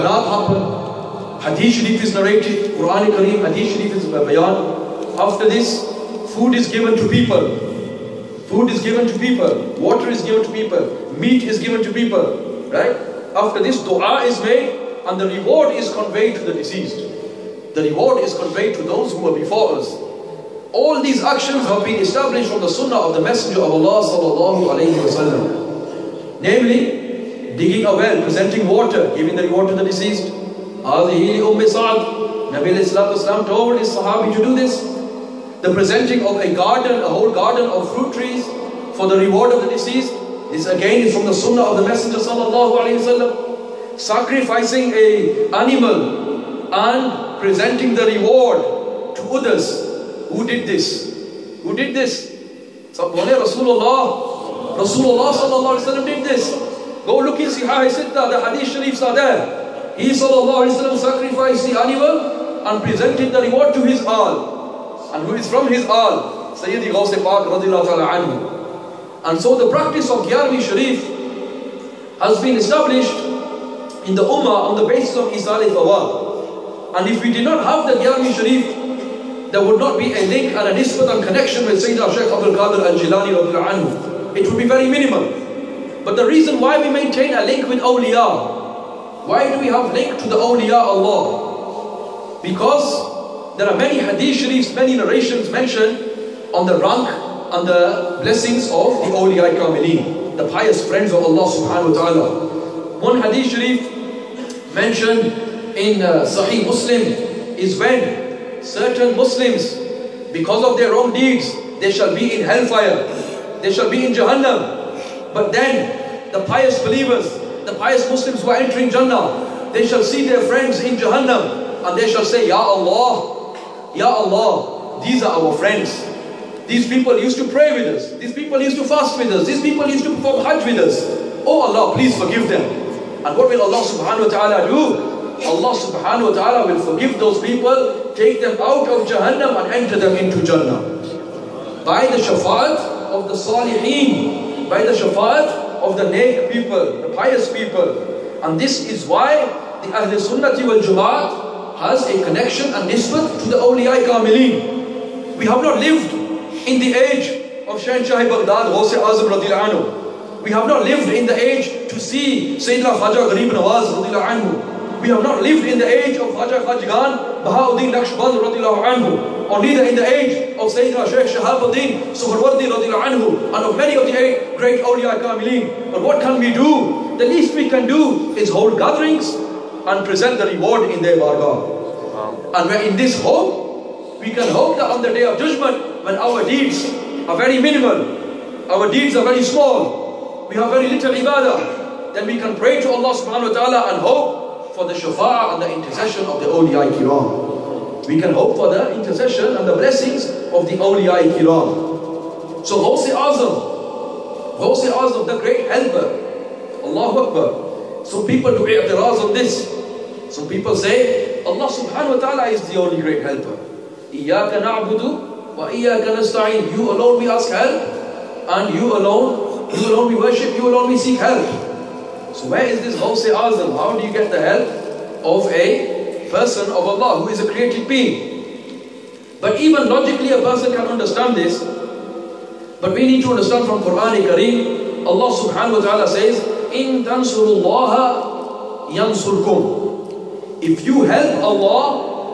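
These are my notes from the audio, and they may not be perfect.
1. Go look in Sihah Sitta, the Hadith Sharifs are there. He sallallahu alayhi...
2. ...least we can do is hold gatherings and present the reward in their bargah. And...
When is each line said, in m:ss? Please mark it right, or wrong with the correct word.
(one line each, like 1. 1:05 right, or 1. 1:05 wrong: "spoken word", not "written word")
1. 0:57 right
2. 2:57 right.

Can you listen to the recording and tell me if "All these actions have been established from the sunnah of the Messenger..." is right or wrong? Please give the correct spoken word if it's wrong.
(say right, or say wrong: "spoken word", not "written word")
right.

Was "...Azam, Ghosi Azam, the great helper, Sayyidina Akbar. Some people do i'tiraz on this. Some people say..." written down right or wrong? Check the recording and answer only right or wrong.
wrong.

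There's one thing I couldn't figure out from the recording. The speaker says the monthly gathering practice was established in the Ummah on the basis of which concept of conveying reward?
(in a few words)
Isal al-Fawad.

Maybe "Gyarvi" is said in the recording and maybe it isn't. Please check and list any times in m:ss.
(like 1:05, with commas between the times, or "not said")
1:10, 1:18.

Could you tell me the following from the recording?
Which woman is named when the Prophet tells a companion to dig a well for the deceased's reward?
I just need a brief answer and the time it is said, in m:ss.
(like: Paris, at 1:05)
Umm Sa'ad, at 0:31.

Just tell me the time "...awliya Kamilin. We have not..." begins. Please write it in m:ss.
2:33.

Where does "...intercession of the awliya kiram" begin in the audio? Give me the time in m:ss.
3:15.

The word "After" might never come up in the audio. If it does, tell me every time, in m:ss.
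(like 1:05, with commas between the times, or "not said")
0:05, 0:13.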